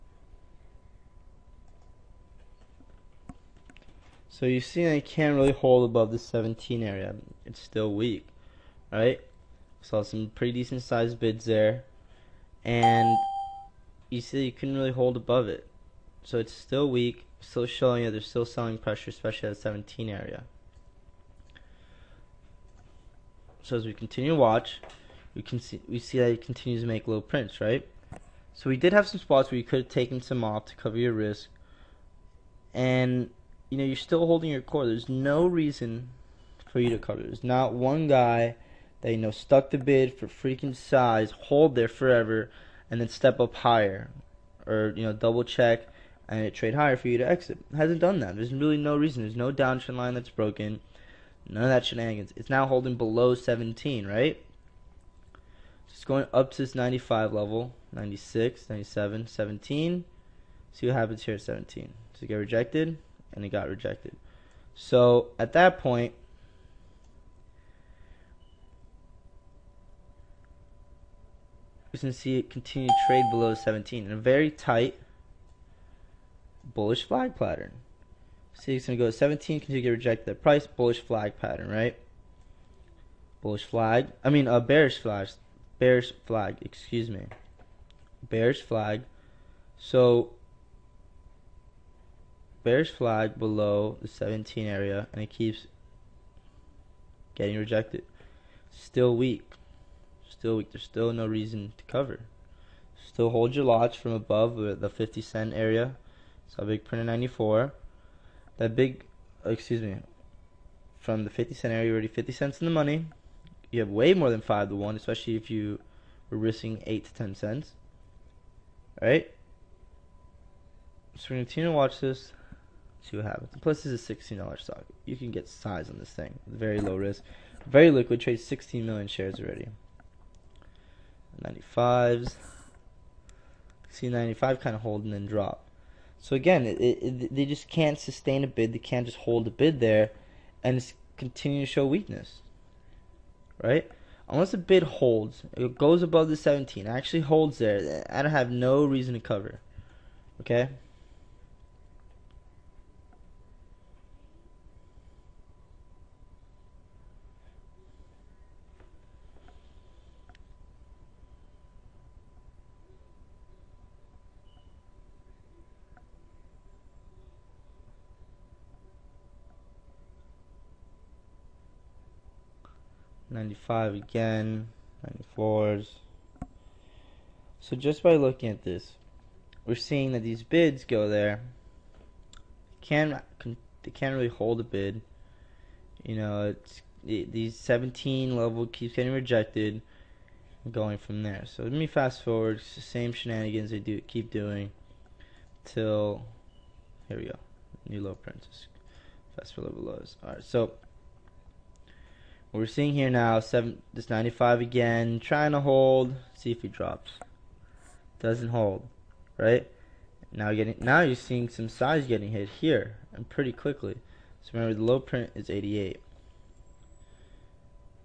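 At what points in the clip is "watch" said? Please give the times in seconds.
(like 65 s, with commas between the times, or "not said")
24 s, 121 s.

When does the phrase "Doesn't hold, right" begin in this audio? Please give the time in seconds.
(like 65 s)
208 s.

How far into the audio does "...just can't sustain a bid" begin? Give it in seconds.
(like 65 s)
137 s.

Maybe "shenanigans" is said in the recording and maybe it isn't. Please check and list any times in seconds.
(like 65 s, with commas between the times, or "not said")
51 s, 193 s.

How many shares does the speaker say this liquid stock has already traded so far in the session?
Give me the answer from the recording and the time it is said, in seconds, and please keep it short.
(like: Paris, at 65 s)
16 million, at 128 s.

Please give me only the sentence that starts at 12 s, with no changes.
And you see you couldn't really hold above it.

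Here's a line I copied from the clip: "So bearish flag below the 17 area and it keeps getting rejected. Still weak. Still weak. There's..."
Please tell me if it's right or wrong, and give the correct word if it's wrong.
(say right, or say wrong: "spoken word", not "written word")
right.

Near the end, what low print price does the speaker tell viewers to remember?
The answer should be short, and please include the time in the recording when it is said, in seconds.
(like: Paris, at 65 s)
88, at 215 s.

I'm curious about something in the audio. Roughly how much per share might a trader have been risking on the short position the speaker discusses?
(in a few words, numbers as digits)
8 to 10 cents.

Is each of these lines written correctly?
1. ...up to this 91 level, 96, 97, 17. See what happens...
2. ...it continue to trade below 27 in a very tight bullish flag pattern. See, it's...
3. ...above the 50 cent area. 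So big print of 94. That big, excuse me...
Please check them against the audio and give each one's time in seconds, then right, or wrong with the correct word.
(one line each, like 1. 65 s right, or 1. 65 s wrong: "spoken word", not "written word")
1. 56 s wrong: "95", not "91"
2. 72 s wrong: "17", not "27"
3. 104 s right.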